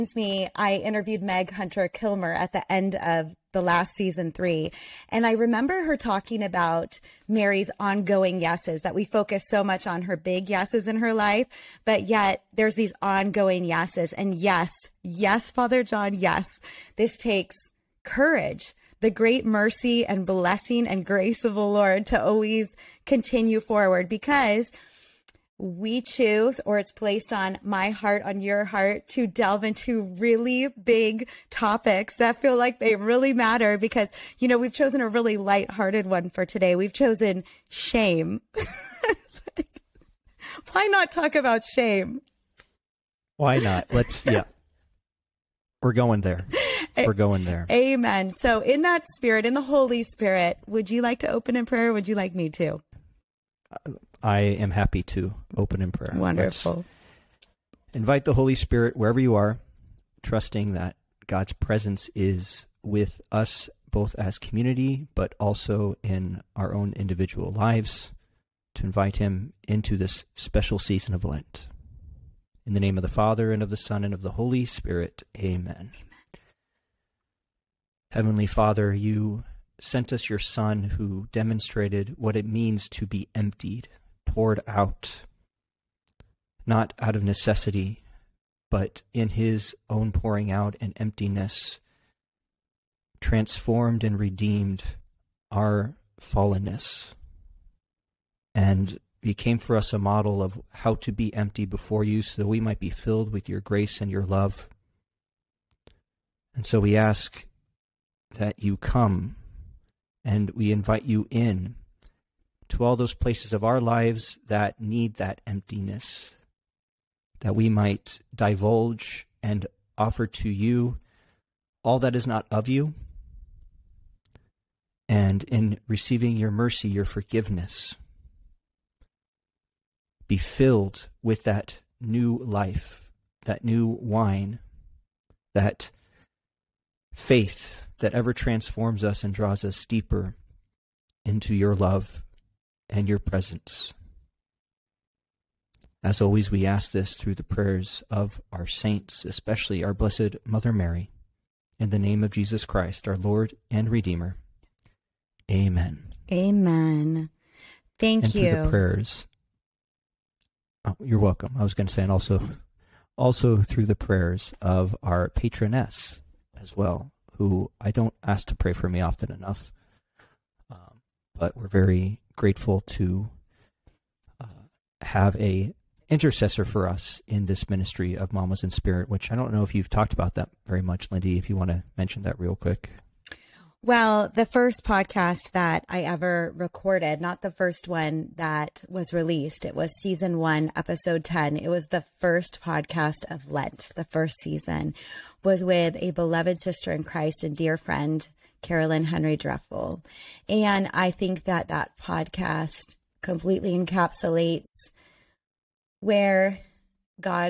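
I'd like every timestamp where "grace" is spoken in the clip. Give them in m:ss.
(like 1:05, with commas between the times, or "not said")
0:21, 1:43.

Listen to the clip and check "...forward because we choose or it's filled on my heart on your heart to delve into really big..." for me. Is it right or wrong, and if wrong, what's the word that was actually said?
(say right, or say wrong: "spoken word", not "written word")
wrong: "placed", not "filled".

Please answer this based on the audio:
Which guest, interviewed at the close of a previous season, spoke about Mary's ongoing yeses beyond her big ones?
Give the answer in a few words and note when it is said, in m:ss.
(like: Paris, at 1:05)
Meg Hunter Kilmer, at 0:01.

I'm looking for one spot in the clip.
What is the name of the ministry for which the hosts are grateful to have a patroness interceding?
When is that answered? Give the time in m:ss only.
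2:58.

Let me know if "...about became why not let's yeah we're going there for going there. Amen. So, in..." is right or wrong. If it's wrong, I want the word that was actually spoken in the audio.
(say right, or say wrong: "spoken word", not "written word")
wrong: "shame", not "became".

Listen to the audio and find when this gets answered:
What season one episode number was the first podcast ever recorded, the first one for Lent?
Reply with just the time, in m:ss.
3:10.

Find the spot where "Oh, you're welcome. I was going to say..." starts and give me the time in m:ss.
2:40.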